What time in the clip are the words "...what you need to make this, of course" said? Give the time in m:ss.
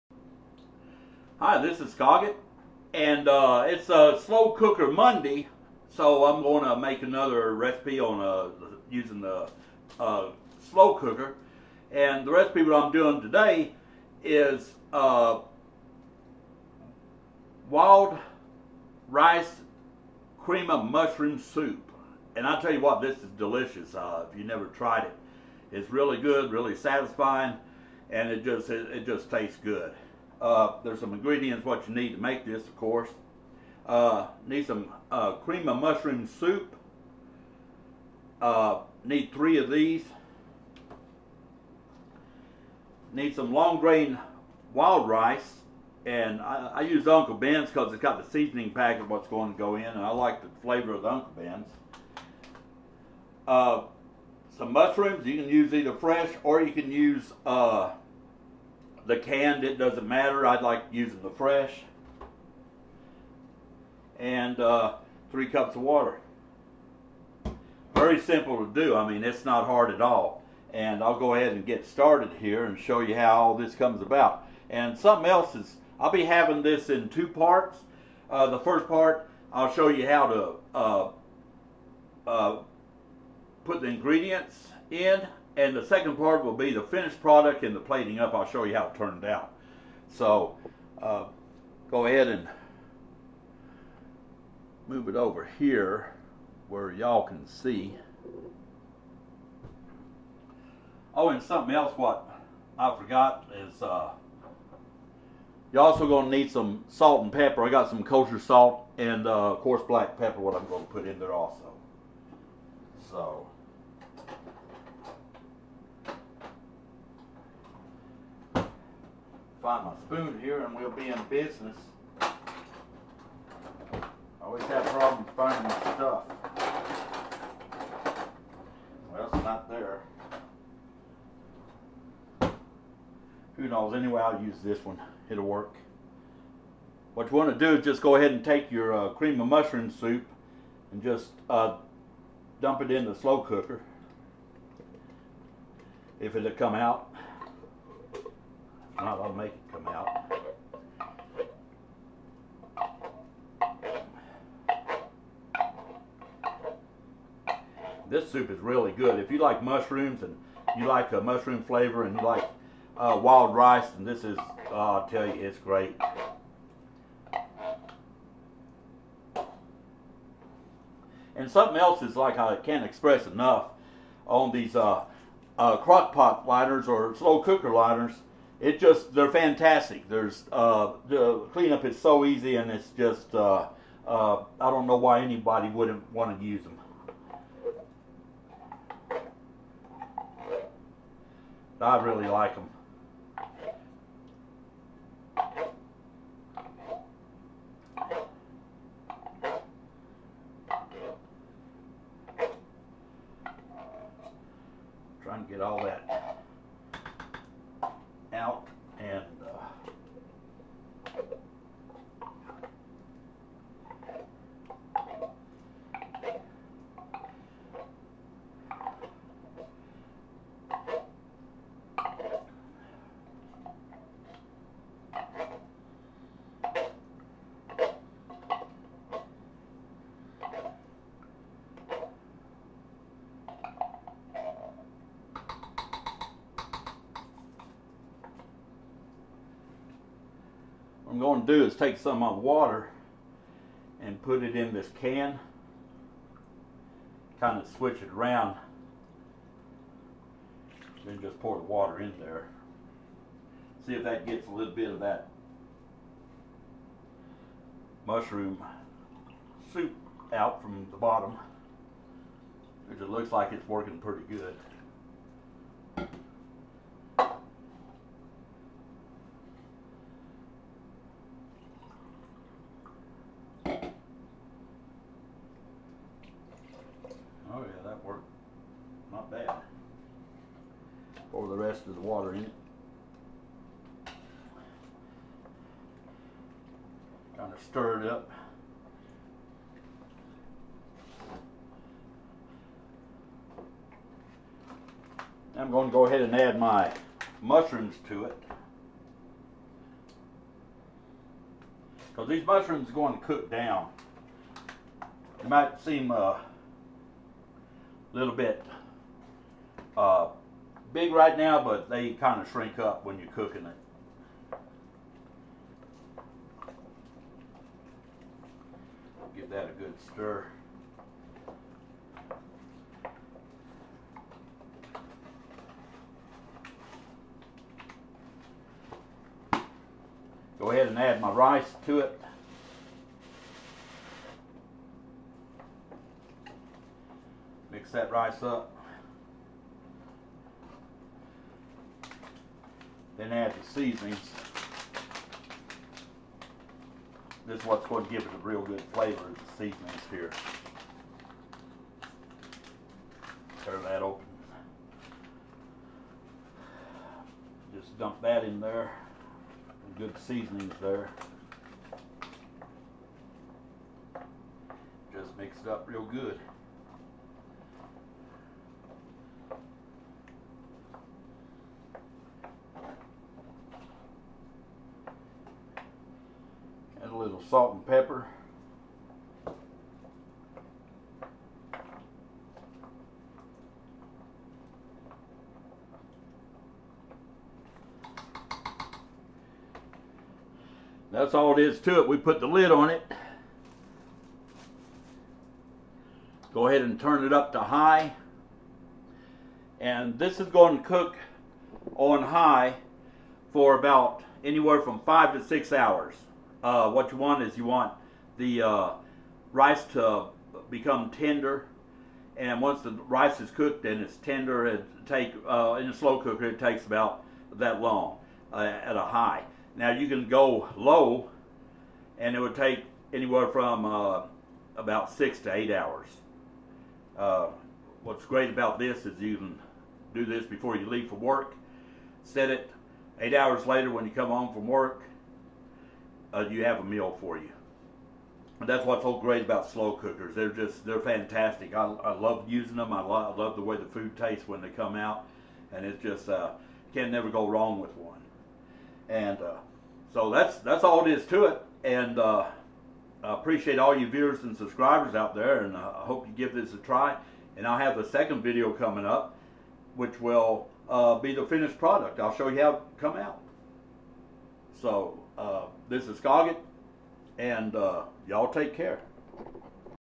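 0:31.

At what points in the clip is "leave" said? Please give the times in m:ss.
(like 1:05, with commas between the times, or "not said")
7:10.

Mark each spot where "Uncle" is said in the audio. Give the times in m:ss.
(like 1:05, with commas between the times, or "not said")
0:47, 0:51.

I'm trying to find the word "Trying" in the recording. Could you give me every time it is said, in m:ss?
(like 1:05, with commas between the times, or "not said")
3:25.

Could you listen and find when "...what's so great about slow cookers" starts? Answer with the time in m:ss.
7:18.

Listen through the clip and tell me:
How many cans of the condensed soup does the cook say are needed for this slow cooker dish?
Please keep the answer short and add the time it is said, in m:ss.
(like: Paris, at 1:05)
3, at 0:39.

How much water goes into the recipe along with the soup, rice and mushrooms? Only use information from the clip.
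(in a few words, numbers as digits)
3 cups.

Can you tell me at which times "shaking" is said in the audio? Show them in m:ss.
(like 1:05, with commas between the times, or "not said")
not said.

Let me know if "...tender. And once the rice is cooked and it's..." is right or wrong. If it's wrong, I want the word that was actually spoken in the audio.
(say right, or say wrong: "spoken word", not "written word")
right.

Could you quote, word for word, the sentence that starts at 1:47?
I got some kosher salt and, uh, of course, black pepper what I'm going to put in there also.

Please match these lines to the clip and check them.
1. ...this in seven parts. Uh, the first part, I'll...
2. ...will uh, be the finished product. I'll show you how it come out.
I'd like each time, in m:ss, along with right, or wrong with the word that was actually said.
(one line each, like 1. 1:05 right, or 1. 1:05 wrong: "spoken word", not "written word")
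1. 1:16 wrong: "two", not "seven"
2. 7:40 right.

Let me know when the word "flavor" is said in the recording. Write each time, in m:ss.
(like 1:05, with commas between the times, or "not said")
0:50, 2:41, 5:48.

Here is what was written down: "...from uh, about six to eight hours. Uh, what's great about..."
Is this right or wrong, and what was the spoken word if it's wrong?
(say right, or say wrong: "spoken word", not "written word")
right.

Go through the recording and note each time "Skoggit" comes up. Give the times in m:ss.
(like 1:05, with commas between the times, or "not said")
0:01, 7:46.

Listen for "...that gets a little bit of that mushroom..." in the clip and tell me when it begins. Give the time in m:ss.
4:14.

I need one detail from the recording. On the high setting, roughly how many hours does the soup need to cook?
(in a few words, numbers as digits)
5 to 6 hours.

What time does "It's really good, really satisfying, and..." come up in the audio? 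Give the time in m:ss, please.
0:25.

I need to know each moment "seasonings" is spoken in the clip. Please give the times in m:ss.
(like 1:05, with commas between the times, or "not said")
0:48, 5:43, 5:49, 6:00.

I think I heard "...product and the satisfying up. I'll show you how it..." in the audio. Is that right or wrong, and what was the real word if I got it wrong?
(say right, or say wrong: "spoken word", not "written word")
wrong: "plating", not "satisfying".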